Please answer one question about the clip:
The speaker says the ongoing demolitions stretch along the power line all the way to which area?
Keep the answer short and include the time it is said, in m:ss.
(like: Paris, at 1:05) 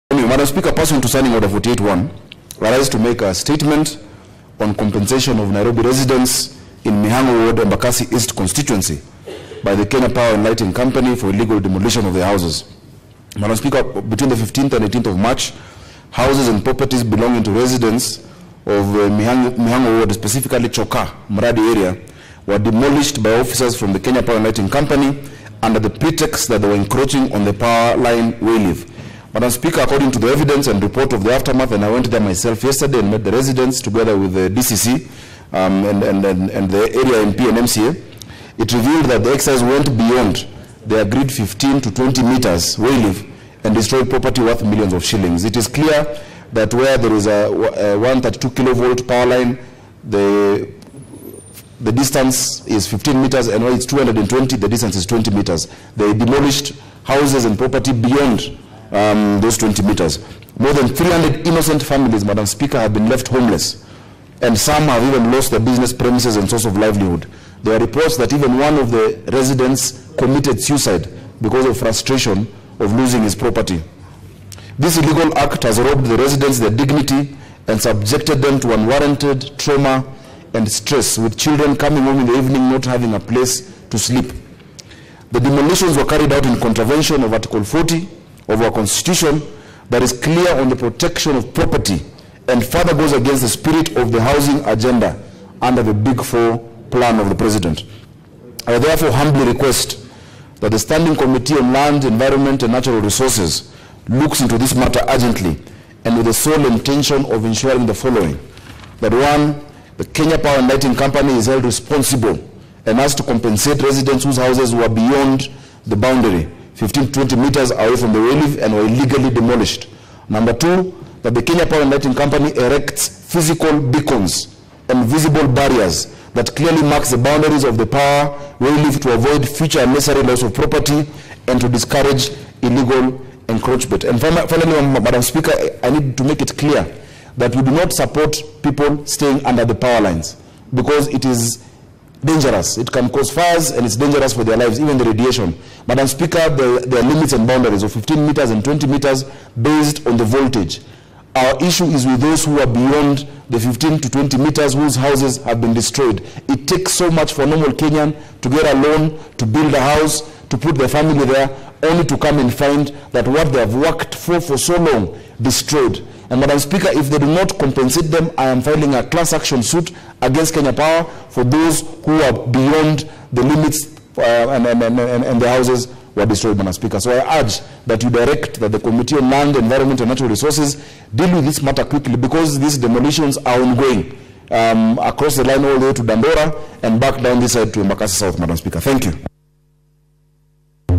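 Dandora, at 3:06.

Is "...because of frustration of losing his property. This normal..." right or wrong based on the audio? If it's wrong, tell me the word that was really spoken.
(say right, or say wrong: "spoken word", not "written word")
wrong: "illegal", not "normal".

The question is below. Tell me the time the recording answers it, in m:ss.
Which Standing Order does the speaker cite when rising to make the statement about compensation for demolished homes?
0:01.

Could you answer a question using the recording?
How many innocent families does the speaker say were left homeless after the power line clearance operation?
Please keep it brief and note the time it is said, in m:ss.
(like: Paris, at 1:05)
More than 300, at 1:00.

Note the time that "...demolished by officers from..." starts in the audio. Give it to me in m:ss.
0:22.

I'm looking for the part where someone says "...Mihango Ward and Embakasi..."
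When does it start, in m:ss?
0:07.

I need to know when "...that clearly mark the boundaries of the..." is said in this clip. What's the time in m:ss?
2:06.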